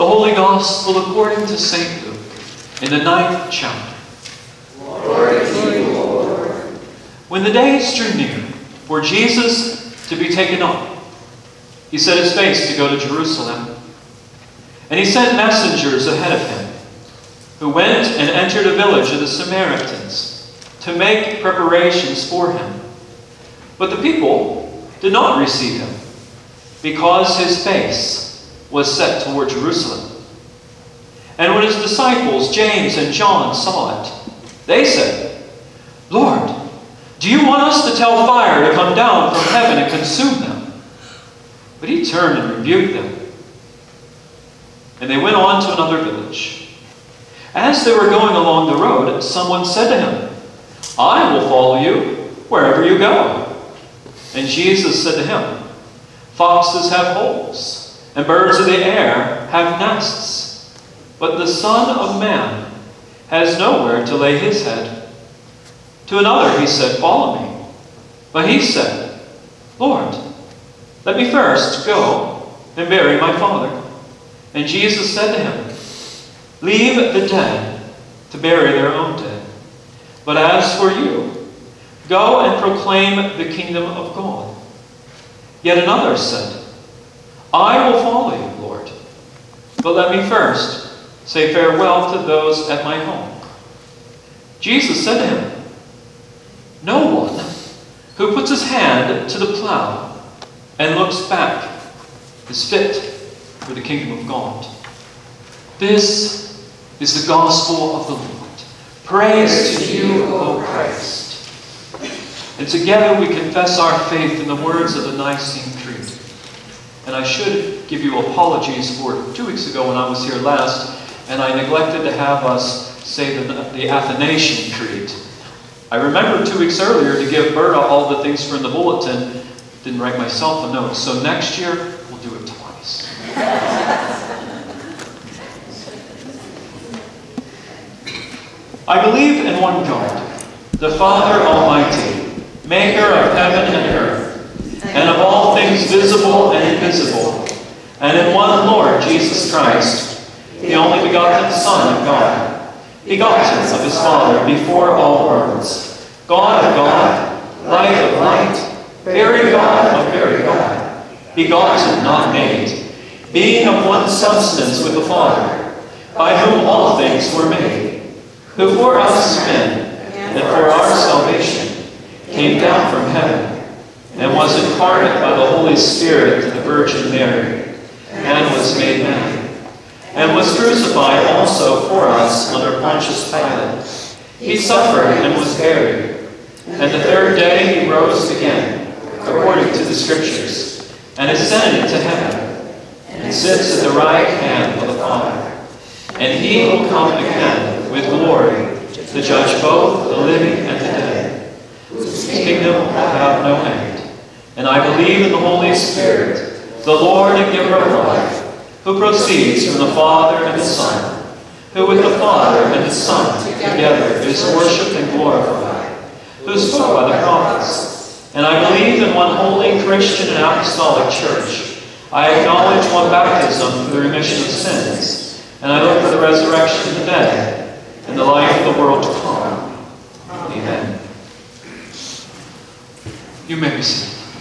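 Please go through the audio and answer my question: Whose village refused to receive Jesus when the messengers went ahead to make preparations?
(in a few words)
Samaritans.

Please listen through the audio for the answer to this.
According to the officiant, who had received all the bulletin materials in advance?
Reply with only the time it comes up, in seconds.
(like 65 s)
127 s.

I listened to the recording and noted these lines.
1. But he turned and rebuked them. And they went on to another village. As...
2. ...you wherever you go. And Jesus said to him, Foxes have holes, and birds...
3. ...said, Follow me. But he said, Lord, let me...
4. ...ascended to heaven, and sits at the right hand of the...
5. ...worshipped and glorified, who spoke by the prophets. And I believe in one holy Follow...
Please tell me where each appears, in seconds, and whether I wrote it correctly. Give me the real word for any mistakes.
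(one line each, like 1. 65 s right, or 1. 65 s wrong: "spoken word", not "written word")
1. 41 s right
2. 51 s right
3. 66 s right
4. 191 s right
5. 214 s wrong: "Christian", not "Follow".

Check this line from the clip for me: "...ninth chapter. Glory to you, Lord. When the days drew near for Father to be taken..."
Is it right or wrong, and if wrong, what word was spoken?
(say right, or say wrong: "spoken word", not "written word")
wrong: "Jesus", not "Father".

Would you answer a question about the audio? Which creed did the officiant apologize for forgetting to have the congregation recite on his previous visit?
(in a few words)
Athanasian Creed.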